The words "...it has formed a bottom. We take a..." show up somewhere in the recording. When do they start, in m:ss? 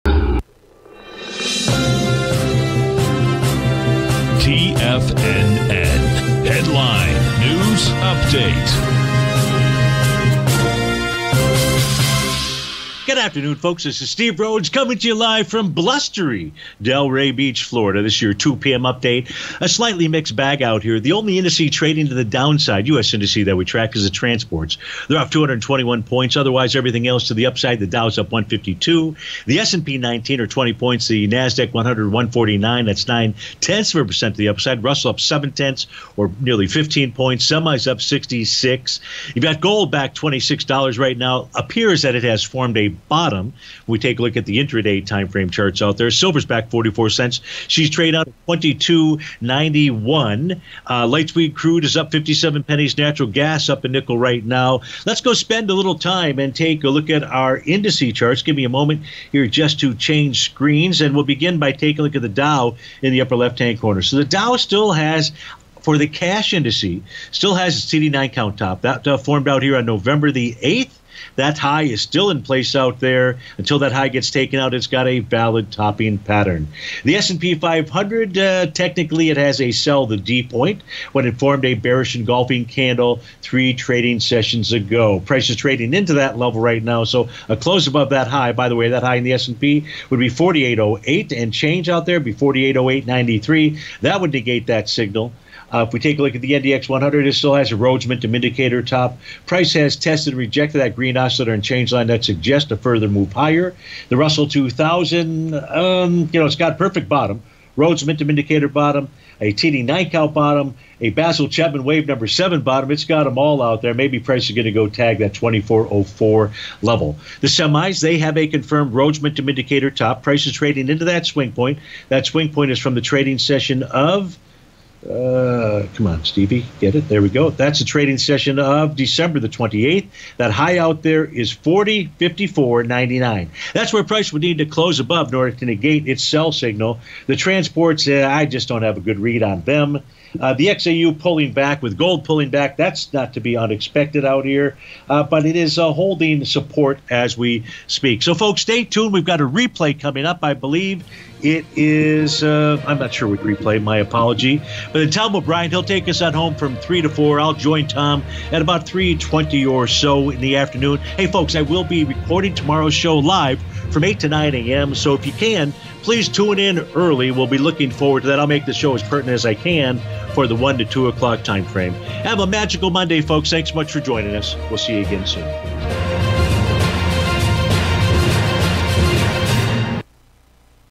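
0:42.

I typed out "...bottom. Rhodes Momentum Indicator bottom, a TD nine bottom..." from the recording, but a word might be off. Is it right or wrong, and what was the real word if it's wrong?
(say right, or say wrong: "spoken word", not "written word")
right.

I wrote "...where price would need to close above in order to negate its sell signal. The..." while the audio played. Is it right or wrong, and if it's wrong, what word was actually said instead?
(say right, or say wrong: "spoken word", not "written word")
right.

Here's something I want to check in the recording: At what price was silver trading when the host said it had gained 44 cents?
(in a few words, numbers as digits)
22.91.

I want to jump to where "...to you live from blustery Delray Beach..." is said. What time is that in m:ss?
0:14.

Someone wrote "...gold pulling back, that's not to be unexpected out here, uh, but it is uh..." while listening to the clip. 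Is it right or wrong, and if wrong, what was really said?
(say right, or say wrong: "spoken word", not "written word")
right.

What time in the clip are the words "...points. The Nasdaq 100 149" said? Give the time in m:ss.
0:30.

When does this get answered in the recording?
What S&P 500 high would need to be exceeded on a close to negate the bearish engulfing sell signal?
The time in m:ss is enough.
1:32.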